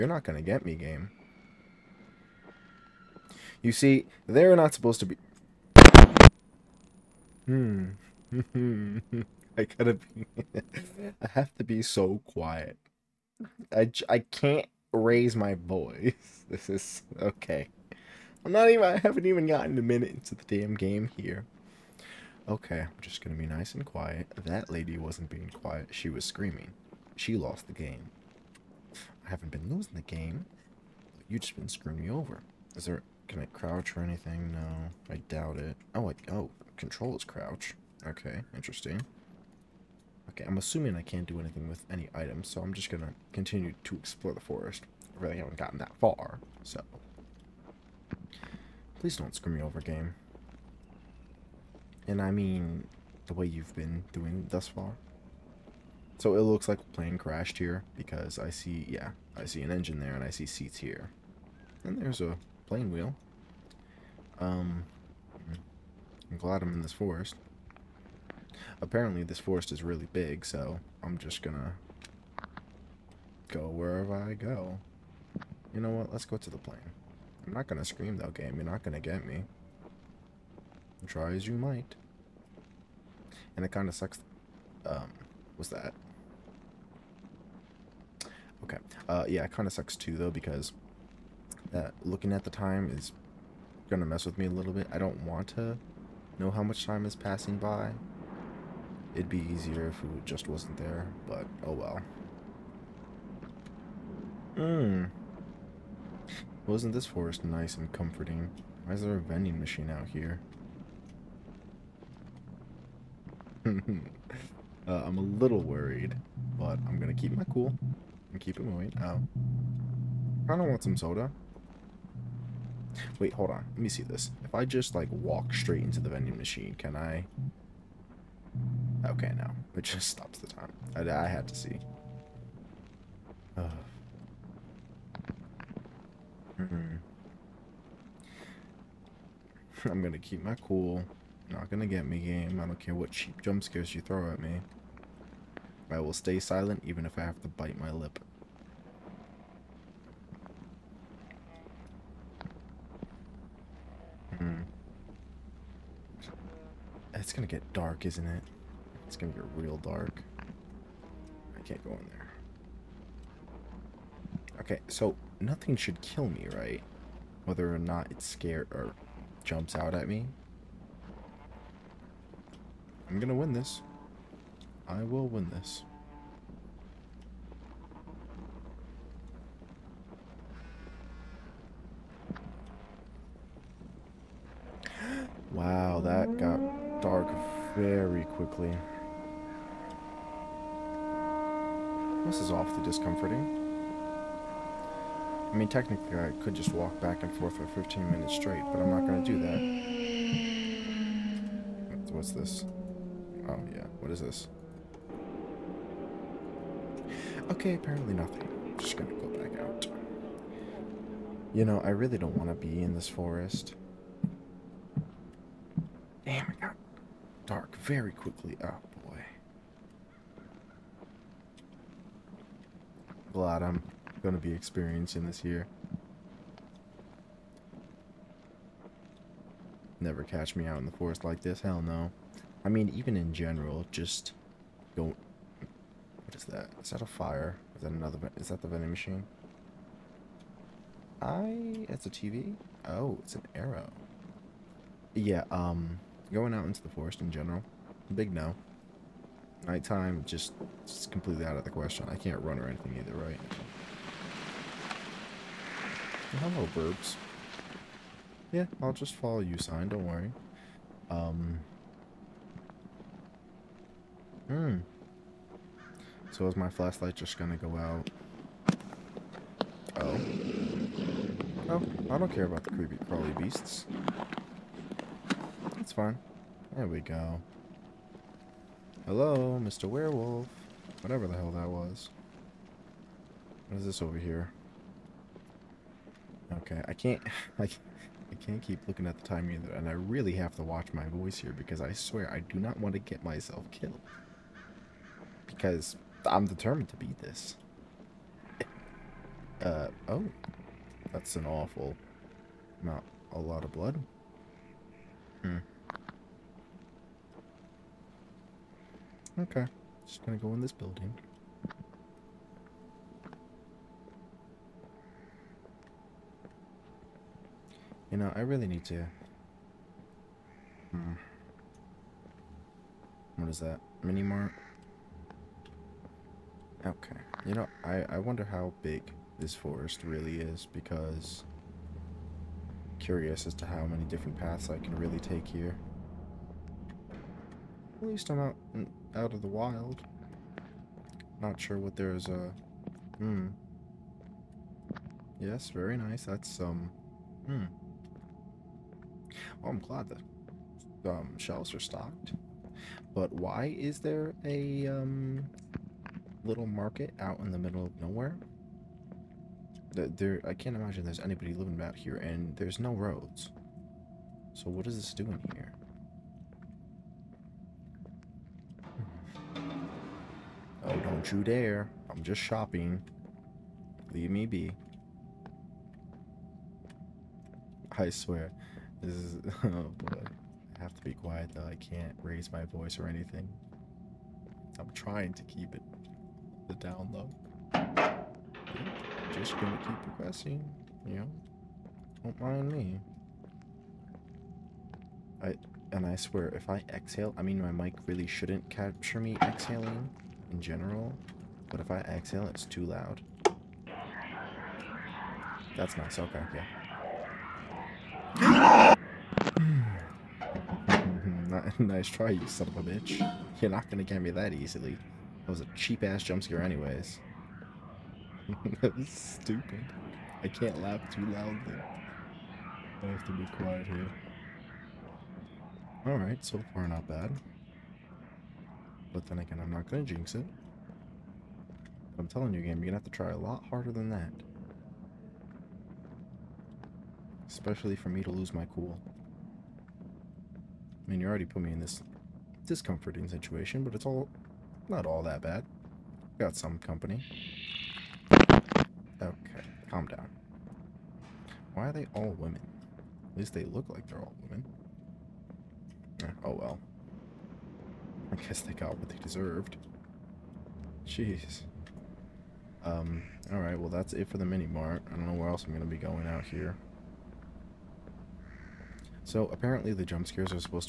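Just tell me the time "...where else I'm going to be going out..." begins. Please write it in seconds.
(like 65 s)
465 s.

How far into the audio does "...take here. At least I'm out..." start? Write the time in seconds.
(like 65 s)
335 s.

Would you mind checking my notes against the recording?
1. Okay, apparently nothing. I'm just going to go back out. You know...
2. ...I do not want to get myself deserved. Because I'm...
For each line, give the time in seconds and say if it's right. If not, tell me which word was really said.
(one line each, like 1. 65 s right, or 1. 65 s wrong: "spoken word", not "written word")
1. 207 s right
2. 292 s wrong: "killed", not "deserved".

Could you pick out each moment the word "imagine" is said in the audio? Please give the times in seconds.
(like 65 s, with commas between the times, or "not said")
360 s.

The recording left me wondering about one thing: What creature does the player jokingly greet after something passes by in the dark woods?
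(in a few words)
Werewolf.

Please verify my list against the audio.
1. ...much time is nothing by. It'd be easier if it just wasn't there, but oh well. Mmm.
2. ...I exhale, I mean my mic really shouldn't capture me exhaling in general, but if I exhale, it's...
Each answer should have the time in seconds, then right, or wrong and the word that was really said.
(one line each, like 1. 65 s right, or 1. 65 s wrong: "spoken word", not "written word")
1. 96 s wrong: "passing", not "nothing"
2. 396 s right.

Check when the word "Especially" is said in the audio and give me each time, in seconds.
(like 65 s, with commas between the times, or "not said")
437 s.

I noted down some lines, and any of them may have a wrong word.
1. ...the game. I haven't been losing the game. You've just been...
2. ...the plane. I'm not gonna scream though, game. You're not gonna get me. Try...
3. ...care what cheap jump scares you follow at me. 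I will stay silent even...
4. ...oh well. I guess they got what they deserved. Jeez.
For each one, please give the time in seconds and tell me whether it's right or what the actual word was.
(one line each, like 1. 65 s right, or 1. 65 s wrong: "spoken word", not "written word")
1. 27 s right
2. 76 s right
3. 142 s wrong: "throw", not "follow"
4. 456 s right.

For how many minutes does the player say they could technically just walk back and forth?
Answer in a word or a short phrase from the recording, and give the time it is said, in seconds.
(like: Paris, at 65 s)
15, at 197 s.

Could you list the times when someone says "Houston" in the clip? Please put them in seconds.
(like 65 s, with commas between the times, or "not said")
not said.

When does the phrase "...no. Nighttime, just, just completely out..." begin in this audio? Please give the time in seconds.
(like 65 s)
248 s.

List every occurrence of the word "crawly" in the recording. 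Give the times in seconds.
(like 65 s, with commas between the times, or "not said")
273 s.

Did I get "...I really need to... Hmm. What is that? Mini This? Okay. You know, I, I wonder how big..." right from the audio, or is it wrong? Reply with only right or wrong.
wrong.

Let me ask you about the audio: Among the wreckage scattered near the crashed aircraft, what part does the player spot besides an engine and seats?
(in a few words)
Plane wheel.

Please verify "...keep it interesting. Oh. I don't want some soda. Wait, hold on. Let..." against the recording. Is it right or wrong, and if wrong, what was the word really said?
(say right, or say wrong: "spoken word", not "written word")
wrong: "moving", not "interesting".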